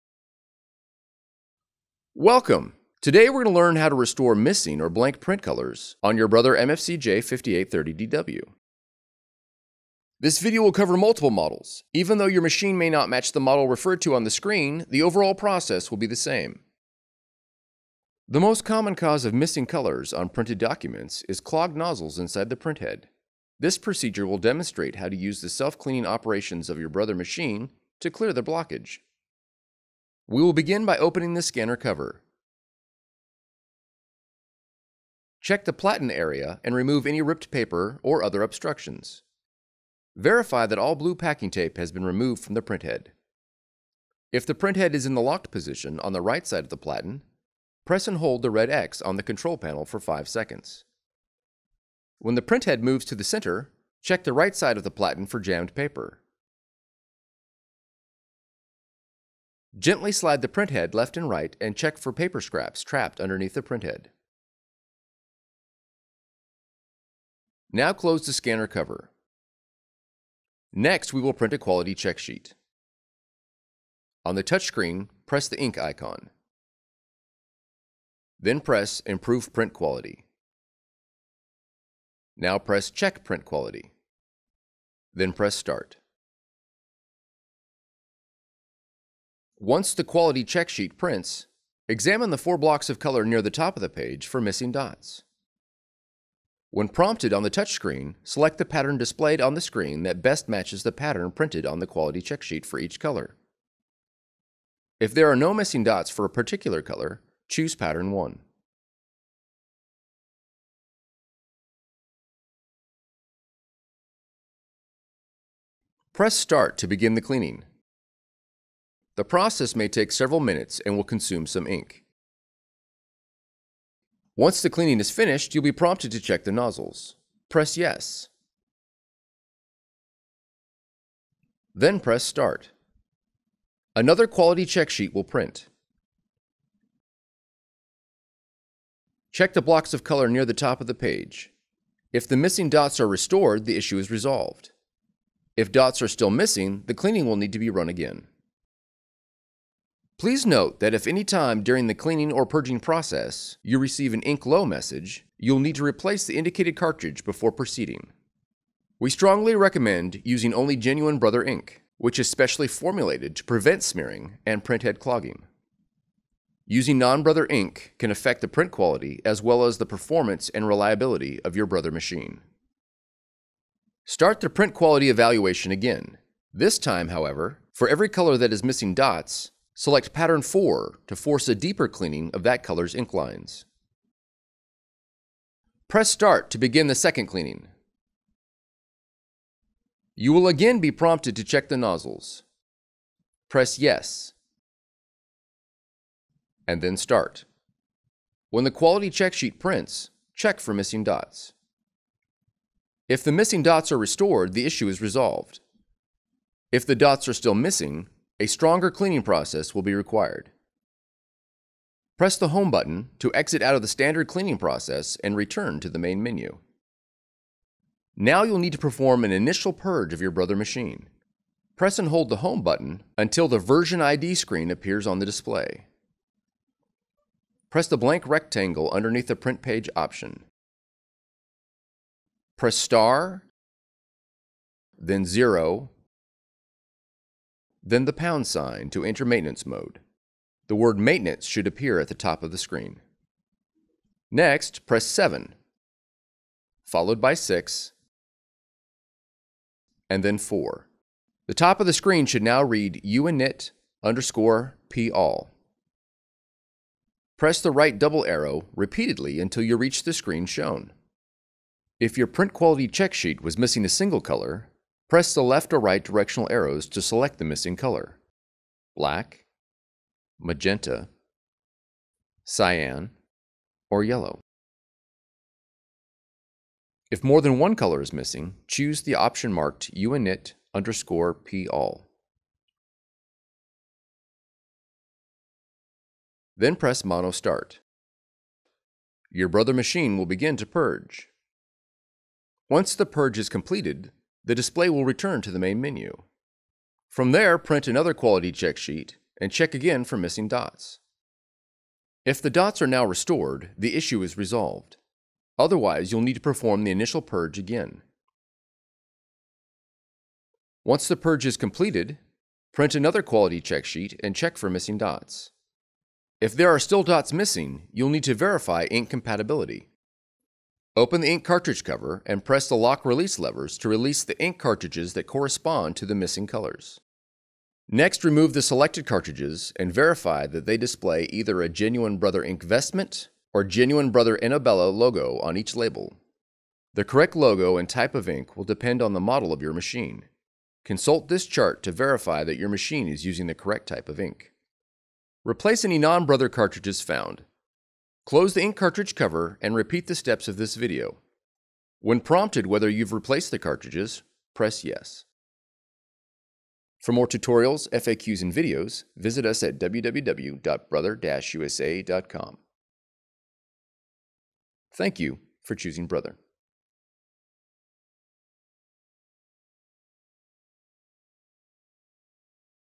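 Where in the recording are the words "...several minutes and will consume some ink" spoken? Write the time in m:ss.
2:00.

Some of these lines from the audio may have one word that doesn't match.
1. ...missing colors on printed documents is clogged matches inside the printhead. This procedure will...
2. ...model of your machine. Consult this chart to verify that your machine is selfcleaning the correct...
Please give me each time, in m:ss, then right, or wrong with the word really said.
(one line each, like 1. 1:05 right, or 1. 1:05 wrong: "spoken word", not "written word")
1. 0:19 wrong: "nozzles", not "matches"
2. 5:39 wrong: "using", not "selfcleaning".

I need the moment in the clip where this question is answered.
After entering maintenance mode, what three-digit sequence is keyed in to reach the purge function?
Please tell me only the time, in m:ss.
4:05.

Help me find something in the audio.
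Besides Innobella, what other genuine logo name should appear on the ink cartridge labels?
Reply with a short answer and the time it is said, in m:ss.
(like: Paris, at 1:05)
INKvestment, at 5:32.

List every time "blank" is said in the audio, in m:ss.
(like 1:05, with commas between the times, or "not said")
0:04, 3:47.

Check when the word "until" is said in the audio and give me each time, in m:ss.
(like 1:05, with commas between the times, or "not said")
3:43, 4:19.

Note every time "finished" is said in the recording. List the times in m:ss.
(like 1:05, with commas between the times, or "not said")
2:05.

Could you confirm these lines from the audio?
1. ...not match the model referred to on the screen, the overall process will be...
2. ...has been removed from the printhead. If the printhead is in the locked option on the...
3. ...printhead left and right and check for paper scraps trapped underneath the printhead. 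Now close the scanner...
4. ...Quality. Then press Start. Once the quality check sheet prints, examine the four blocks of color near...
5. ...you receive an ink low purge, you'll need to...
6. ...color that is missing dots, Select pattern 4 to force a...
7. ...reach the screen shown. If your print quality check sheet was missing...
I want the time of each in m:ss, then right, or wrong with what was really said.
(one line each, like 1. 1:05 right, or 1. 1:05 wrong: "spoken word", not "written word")
1. 0:12 right
2. 0:41 wrong: "position", not "option"
3. 1:00 right
4. 1:23 right
5. 2:33 wrong: "message", not "purge"
6. 2:58 right
7. 4:19 right.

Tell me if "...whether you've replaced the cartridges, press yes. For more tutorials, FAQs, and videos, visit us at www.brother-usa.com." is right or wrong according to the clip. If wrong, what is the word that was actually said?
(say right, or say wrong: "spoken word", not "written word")
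right.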